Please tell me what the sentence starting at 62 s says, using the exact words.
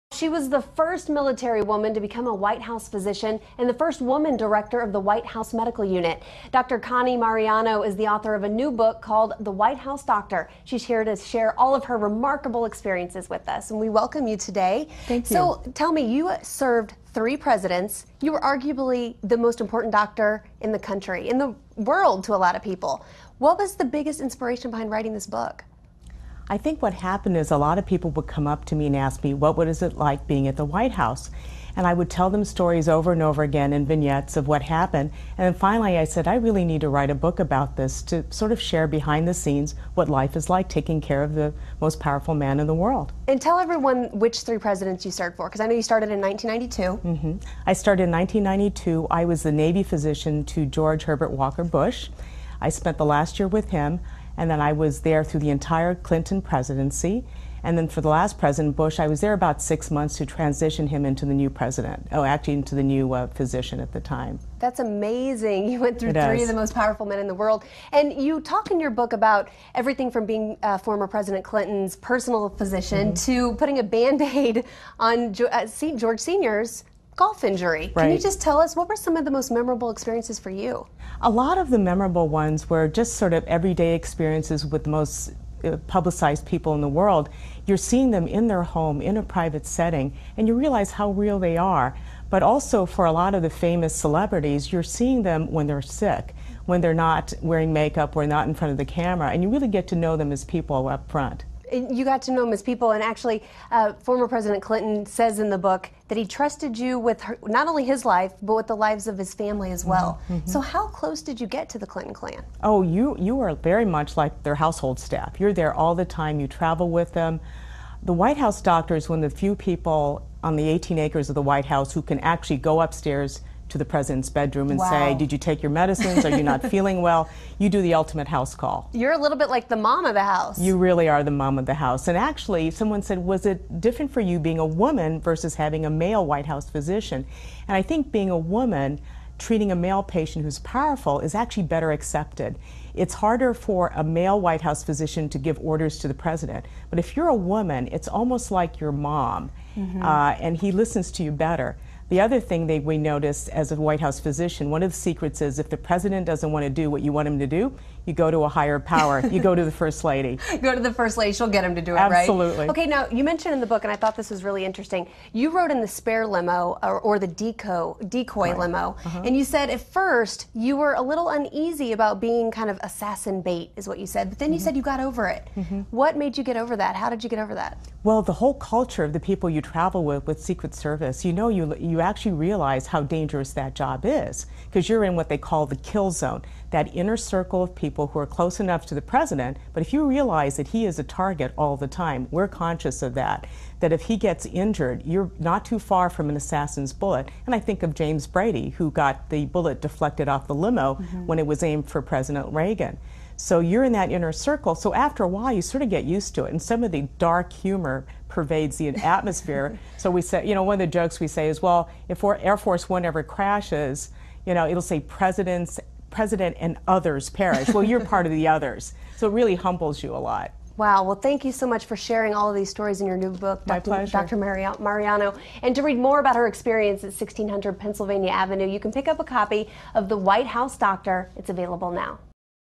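Oh, actually, into the new uh, physician at the time.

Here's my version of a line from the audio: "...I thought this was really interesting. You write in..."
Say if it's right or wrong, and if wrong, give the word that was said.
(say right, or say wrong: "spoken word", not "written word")
wrong: "wrote", not "write".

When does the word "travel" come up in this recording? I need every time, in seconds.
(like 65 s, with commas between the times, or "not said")
116 s, 179 s.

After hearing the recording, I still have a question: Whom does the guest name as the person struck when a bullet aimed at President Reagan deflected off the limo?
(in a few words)
James Brady.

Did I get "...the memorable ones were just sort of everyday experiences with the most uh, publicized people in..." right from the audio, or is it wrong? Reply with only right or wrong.
right.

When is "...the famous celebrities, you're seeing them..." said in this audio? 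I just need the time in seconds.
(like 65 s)
93 s.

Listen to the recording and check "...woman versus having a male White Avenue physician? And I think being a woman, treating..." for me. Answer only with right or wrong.
wrong.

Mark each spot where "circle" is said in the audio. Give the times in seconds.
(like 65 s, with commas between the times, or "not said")
187 s, 204 s.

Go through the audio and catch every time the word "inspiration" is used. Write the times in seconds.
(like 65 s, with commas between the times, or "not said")
24 s.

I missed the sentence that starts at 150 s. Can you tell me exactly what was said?
uh, and he listens to you better.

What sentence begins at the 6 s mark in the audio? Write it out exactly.
Connie Mariano is the author of a new book called The White House Doctor.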